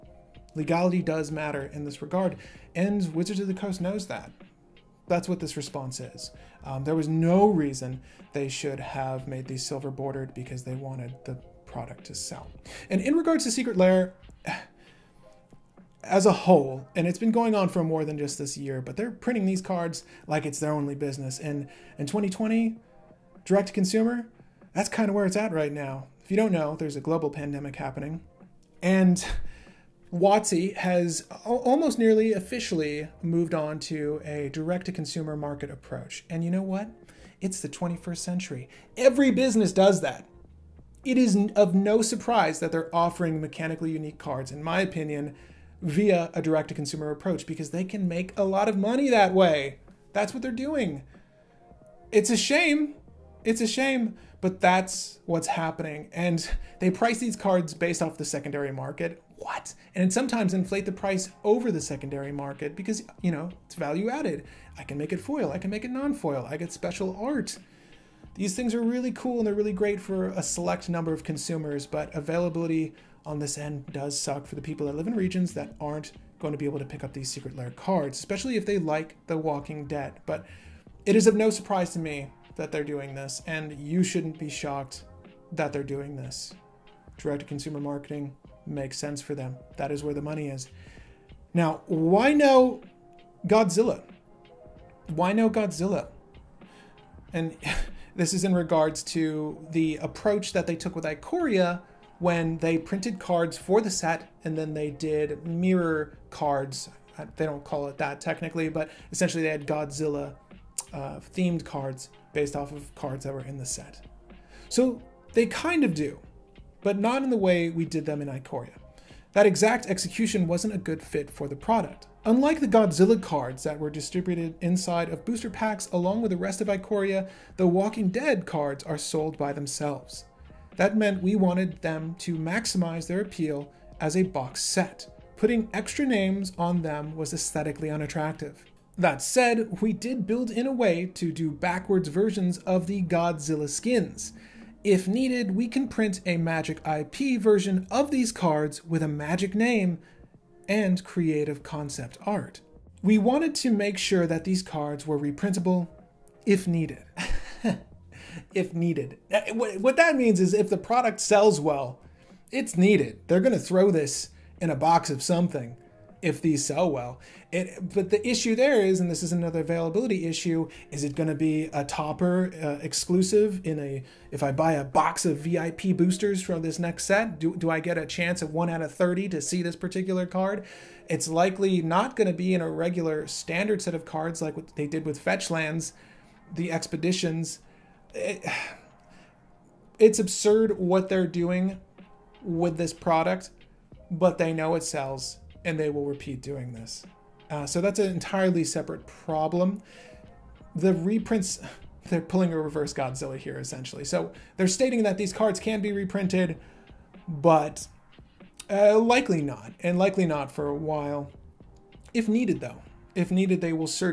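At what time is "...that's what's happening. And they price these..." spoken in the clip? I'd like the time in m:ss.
0:54.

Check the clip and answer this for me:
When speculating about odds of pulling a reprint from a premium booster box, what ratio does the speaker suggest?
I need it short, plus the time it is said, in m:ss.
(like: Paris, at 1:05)
1 out of 30, at 2:58.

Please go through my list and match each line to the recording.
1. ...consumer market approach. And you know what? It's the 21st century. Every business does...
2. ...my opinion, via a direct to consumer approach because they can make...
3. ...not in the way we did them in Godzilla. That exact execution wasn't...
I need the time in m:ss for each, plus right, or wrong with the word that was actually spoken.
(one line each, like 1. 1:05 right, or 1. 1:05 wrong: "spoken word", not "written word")
1. 0:34 right
2. 0:44 right
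3. 1:56 wrong: "Ikoria", not "Godzilla".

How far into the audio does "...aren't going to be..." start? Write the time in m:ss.
1:15.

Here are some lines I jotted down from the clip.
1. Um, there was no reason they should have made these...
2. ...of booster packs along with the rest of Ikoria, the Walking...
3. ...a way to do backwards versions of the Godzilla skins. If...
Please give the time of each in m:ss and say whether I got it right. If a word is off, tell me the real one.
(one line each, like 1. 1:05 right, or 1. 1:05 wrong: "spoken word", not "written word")
1. 0:06 right
2. 2:05 right
3. 2:20 right.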